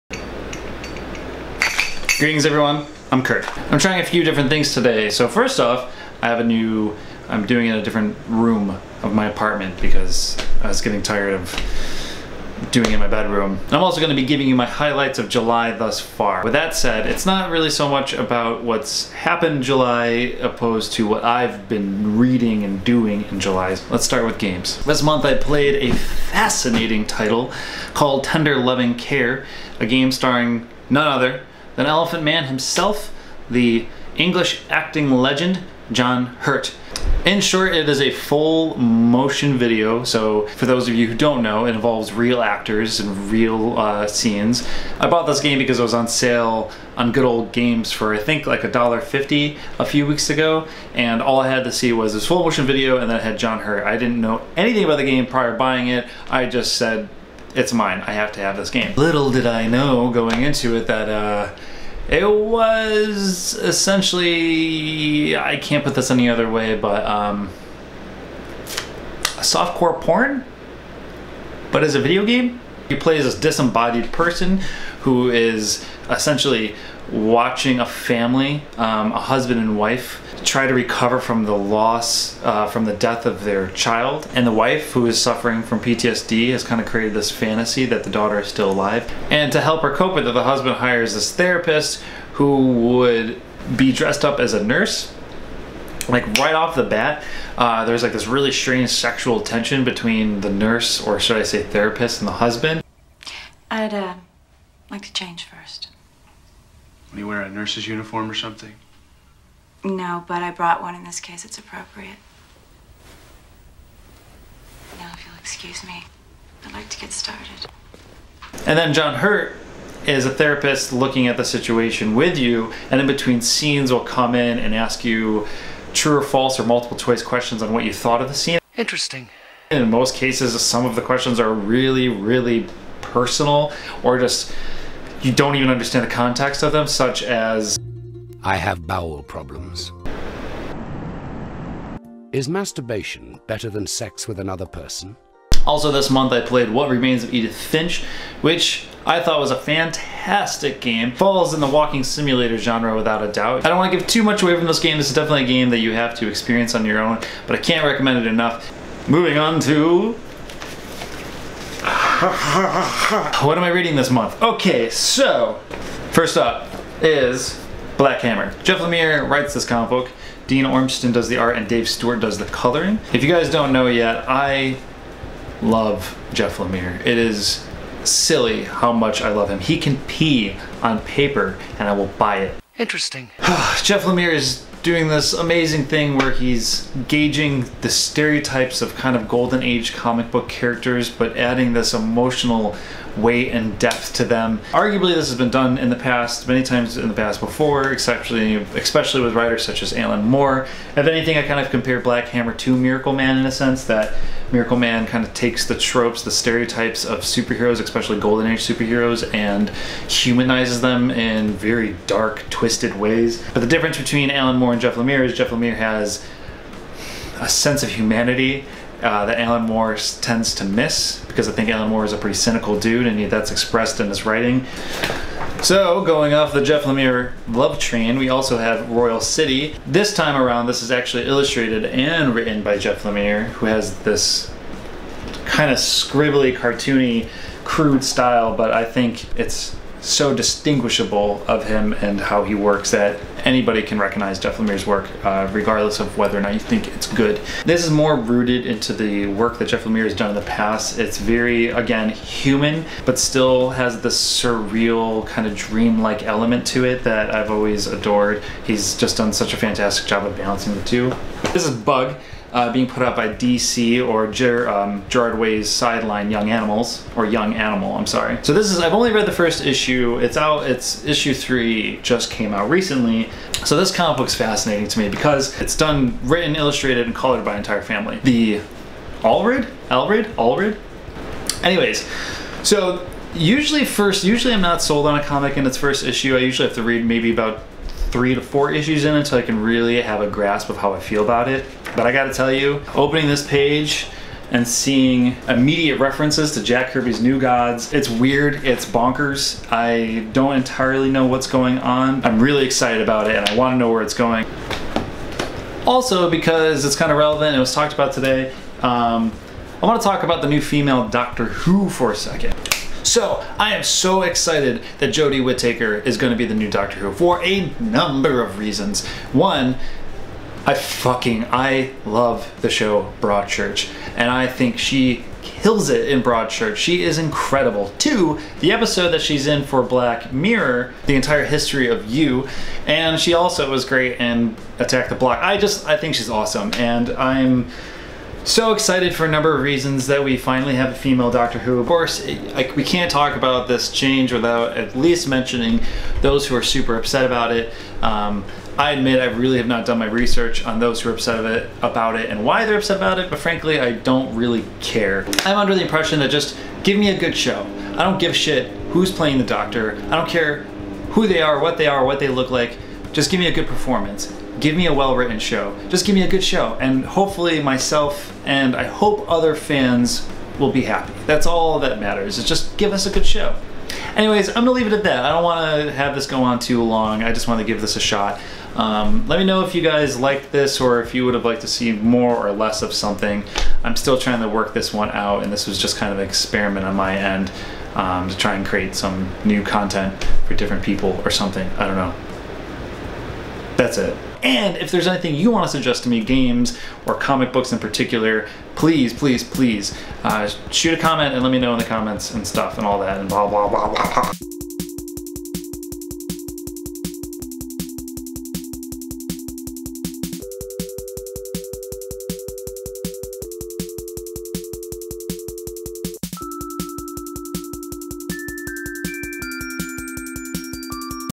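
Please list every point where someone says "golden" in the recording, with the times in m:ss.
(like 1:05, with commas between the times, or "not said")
3:09, 3:28.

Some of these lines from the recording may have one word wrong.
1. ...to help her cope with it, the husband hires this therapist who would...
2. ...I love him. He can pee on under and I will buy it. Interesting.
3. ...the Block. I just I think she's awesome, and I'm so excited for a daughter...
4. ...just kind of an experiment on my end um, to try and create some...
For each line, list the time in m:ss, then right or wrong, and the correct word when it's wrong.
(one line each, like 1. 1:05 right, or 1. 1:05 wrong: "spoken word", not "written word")
1. 1:29 right
2. 2:59 wrong: "paper", not "under"
3. 5:35 wrong: "number", not "daughter"
4. 6:25 right.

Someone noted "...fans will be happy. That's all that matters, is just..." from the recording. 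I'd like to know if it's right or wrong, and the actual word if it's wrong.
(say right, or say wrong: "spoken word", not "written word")
right.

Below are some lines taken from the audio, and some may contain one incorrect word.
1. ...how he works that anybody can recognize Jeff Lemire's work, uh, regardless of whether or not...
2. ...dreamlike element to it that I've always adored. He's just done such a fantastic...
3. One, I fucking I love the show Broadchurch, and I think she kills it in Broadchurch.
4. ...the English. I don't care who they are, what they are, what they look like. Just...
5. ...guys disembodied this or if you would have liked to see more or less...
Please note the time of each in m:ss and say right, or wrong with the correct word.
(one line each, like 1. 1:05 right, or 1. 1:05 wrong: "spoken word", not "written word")
1. 4:02 right
2. 4:15 right
3. 5:19 right
4. 5:59 wrong: "Doctor", not "English"
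5. 6:19 wrong: "liked", not "disembodied".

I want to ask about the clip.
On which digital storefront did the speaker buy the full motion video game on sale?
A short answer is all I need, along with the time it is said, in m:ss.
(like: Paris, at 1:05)
Good Old Games, at 0:47.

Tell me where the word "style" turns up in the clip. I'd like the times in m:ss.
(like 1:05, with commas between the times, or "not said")
3:58.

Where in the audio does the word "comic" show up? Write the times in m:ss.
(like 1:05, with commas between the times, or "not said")
2:49, 3:09, 4:33, 4:45, 6:37.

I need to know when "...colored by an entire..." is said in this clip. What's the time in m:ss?
4:37.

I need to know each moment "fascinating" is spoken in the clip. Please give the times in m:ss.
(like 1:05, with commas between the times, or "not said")
0:25, 4:34.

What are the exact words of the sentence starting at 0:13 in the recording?
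I'm also gonna be giving you my highlights of July thus far.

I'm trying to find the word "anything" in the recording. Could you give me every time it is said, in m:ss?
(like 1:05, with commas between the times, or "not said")
0:54, 3:21, 6:35.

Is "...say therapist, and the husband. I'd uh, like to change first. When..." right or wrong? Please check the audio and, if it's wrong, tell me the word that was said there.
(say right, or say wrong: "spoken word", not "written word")
right.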